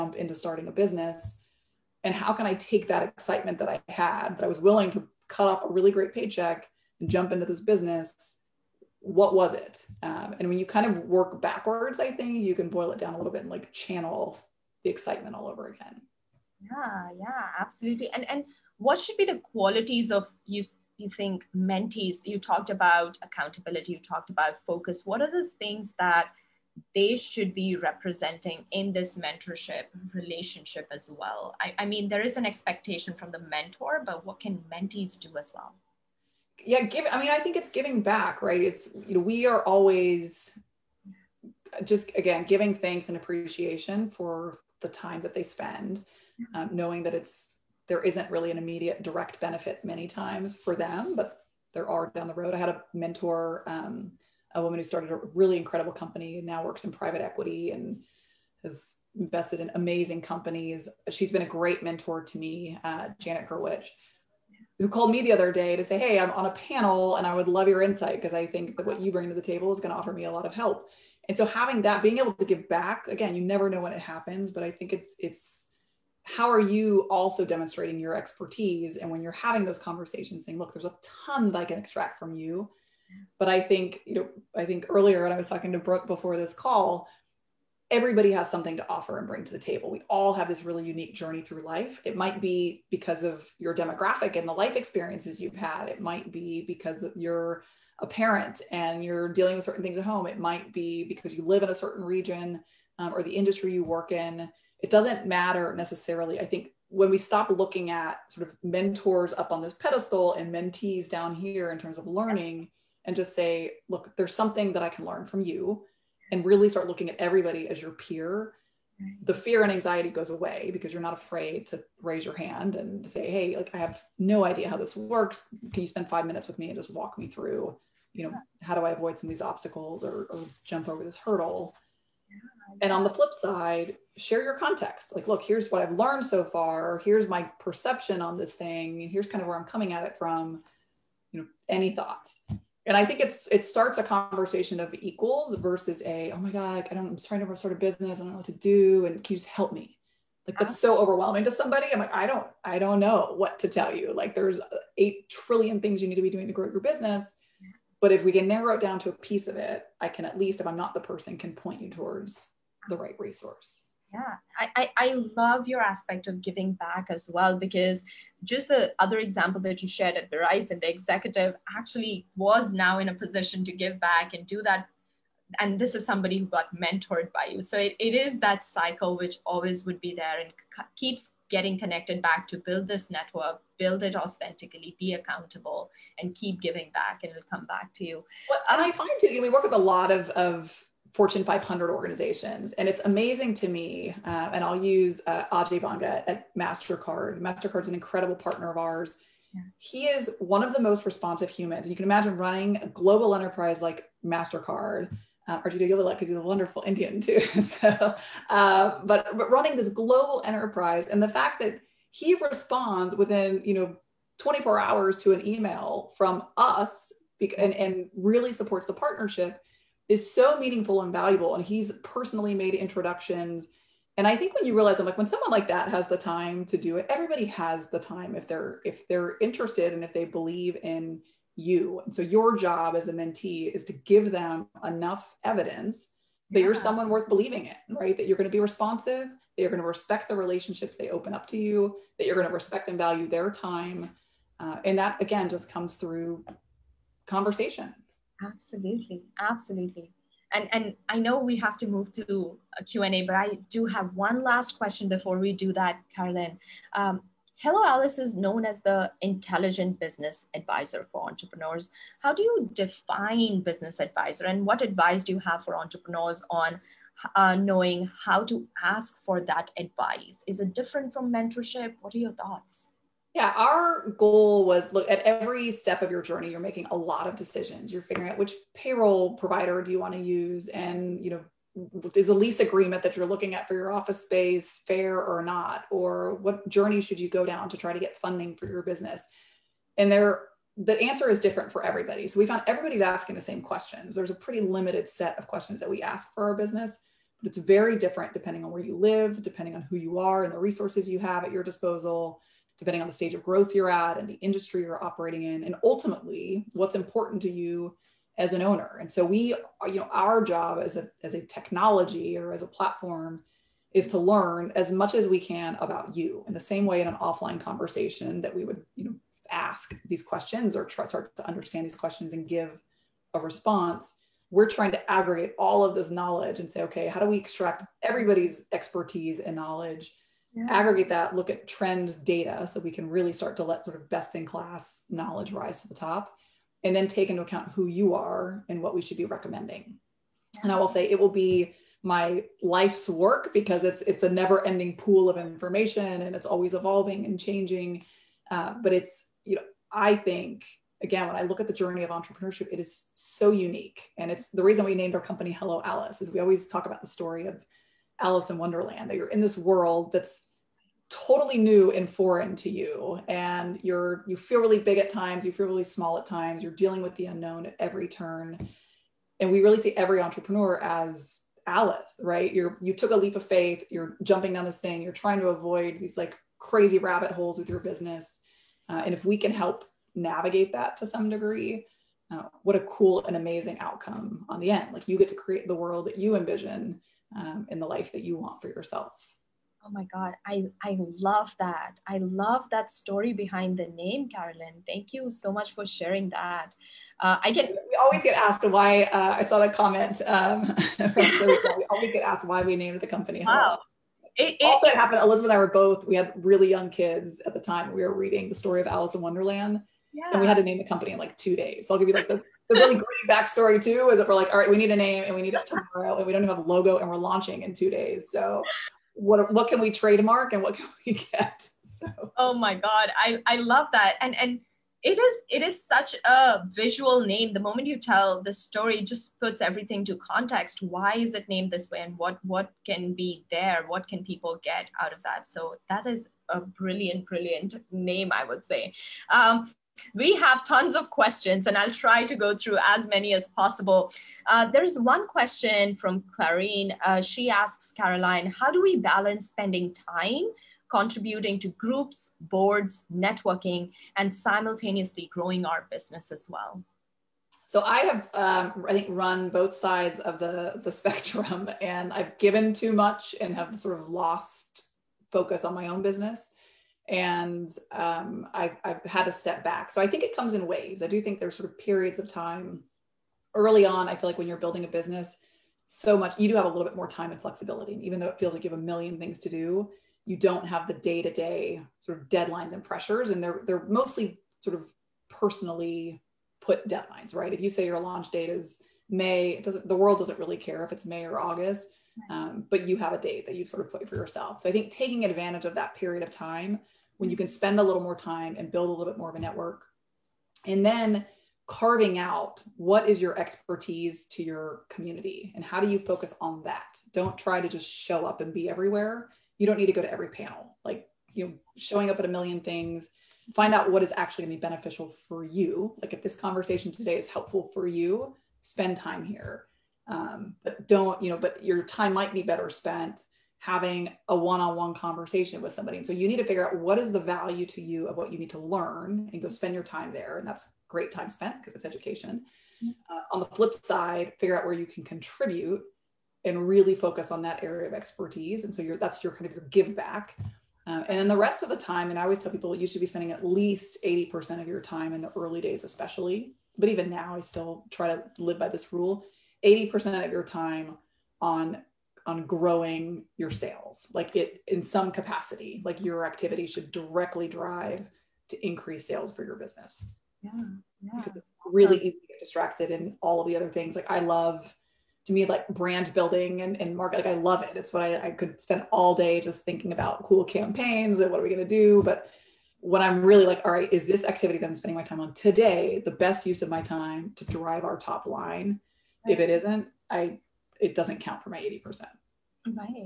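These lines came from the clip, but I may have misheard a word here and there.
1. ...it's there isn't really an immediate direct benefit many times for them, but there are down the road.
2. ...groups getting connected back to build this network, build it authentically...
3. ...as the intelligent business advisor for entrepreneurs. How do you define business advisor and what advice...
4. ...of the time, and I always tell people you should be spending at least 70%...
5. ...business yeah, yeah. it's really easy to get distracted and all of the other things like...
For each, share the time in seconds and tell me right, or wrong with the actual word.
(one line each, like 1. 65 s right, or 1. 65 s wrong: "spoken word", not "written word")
1. 47 s right
2. 180 s wrong: "keeps", not "groups"
3. 258 s right
4. 541 s wrong: "80", not "70"
5. 559 s right.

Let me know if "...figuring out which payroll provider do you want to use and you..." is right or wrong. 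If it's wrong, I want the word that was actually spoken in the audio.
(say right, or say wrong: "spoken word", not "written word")
right.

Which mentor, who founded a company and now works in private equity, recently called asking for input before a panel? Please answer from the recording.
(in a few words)
Janet Gerwich.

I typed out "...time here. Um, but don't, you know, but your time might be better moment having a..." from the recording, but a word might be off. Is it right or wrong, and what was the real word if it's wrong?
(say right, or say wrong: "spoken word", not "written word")
wrong: "spent", not "moment".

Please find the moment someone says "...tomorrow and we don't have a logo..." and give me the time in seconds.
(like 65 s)
415 s.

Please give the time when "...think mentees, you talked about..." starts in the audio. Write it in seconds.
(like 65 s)
21 s.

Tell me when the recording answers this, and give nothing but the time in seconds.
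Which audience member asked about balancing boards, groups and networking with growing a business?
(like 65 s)
446 s.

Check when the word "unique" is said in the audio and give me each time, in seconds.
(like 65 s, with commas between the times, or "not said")
90 s, 353 s.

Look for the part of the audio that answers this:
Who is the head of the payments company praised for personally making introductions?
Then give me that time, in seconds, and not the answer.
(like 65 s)
195 s.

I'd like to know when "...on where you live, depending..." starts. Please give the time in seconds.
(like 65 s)
298 s.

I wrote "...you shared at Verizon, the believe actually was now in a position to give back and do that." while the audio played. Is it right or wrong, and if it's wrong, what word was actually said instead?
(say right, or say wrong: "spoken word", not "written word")
wrong: "executive", not "believe".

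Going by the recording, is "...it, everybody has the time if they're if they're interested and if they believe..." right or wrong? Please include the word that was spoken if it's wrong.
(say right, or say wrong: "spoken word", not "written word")
right.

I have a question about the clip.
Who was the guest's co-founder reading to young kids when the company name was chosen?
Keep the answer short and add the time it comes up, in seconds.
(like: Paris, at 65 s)
Elizabeth, at 405 s.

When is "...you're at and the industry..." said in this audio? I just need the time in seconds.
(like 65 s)
303 s.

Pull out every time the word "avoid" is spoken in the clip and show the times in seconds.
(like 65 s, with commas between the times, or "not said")
128 s, 375 s.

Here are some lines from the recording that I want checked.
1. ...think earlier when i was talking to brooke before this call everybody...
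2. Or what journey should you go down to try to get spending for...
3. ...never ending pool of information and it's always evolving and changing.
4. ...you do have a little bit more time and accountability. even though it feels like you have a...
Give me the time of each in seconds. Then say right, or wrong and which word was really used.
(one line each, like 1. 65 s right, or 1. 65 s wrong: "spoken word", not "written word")
1. 84 s right
2. 285 s wrong: "funding", not "spending"
3. 344 s right
4. 476 s wrong: "flexibility", not "accountability".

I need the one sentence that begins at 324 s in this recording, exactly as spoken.
We're trying to aggregate all of this knowledge and say, okay, how do we extract everybody's expertise and knowledge yeah.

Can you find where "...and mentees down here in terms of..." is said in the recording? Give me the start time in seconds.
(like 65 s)
110 s.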